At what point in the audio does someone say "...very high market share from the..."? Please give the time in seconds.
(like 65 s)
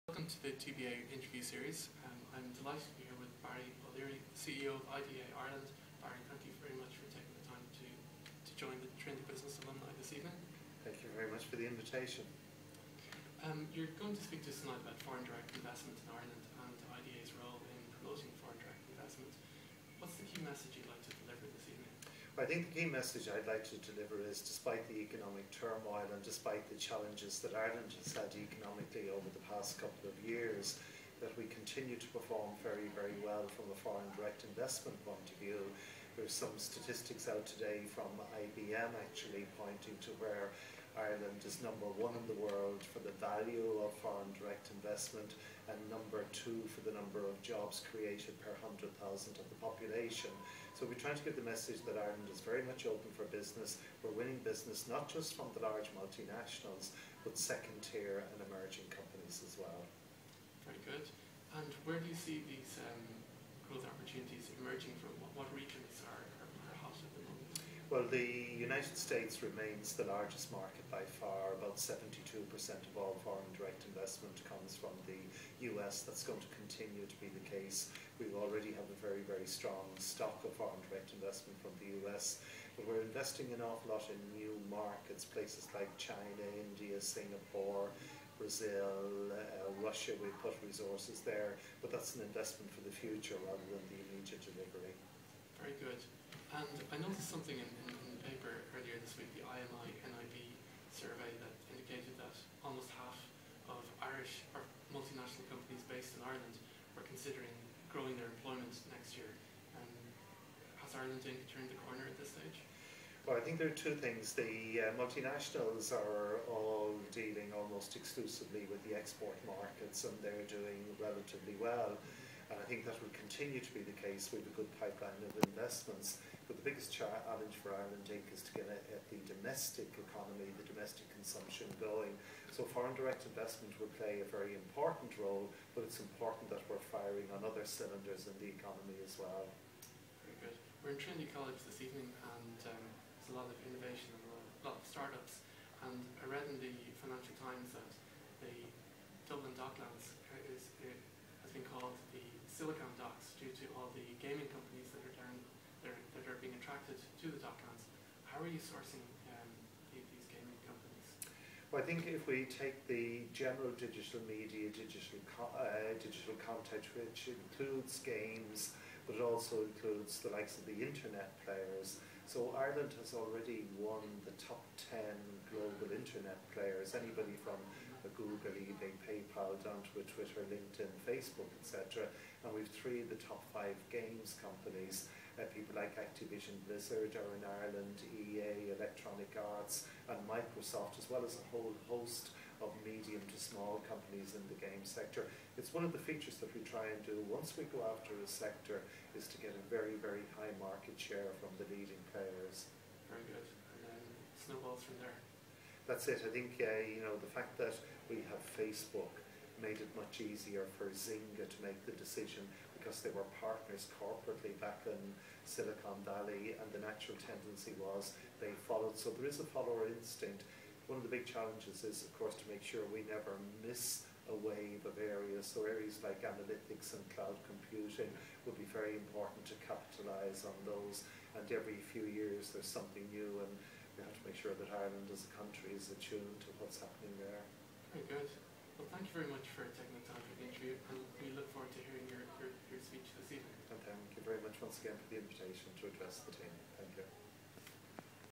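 199 s.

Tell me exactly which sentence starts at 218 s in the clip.
So there is a follower instinct.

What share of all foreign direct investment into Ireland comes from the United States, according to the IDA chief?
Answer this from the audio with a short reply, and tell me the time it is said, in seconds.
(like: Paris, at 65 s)
72%, at 71 s.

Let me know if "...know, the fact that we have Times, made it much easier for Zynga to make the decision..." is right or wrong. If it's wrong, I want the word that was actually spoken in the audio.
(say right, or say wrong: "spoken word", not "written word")
wrong: "Facebook", not "Times".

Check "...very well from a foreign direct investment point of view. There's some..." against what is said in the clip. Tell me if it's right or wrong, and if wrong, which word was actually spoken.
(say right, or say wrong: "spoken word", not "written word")
right.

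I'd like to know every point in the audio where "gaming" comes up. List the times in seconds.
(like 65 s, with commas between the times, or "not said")
154 s, 160 s.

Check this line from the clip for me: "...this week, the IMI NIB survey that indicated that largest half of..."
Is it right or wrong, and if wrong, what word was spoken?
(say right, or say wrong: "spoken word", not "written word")
wrong: "almost", not "largest".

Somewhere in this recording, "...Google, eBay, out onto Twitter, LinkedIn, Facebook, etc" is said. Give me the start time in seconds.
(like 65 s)
178 s.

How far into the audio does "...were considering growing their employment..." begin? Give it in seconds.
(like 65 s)
106 s.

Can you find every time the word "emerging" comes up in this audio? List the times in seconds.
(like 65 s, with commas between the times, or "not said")
58 s, 64 s.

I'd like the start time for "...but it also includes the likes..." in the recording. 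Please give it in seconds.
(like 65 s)
169 s.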